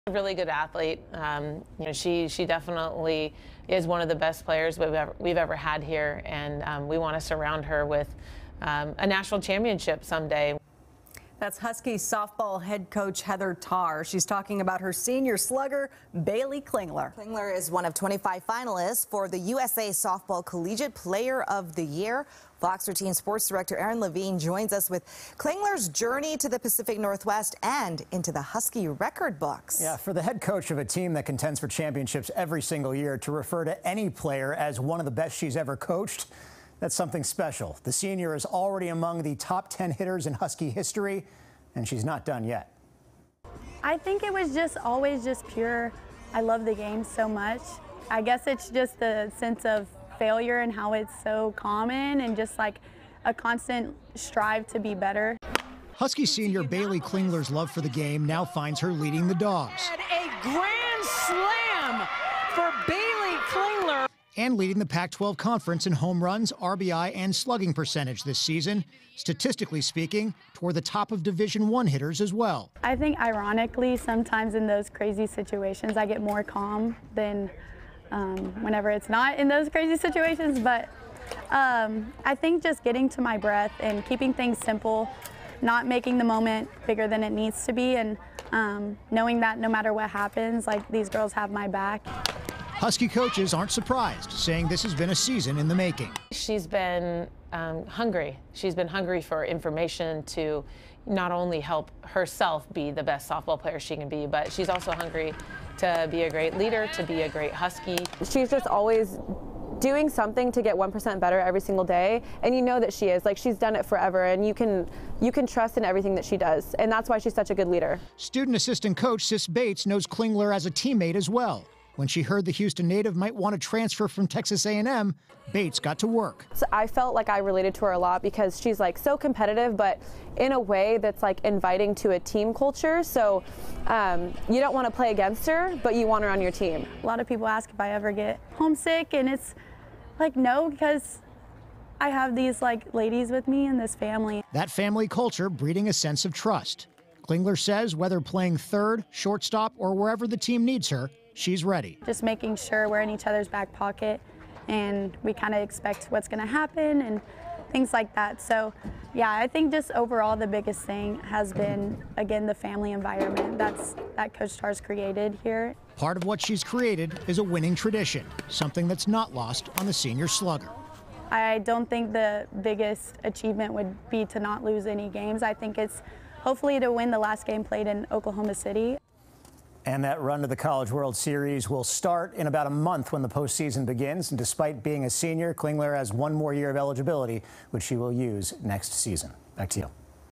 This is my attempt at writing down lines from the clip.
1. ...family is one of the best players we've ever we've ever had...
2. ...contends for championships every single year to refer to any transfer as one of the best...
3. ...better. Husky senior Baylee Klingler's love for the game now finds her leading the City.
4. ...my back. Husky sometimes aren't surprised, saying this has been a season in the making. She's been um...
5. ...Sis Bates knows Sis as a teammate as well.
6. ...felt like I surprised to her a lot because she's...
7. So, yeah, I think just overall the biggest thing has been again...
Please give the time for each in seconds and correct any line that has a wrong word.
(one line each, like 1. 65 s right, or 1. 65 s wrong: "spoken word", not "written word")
1. 2 s wrong: "definitely", not "family"
2. 31 s wrong: "player", not "transfer"
3. 54 s wrong: "Dawgs", not "City"
4. 91 s wrong: "coaches", not "sometimes"
5. 119 s wrong: "Klingler", not "Sis"
6. 126 s wrong: "related", not "surprised"
7. 158 s right.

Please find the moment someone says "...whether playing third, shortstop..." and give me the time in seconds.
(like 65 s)
147 s.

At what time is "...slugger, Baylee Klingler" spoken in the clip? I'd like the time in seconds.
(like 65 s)
15 s.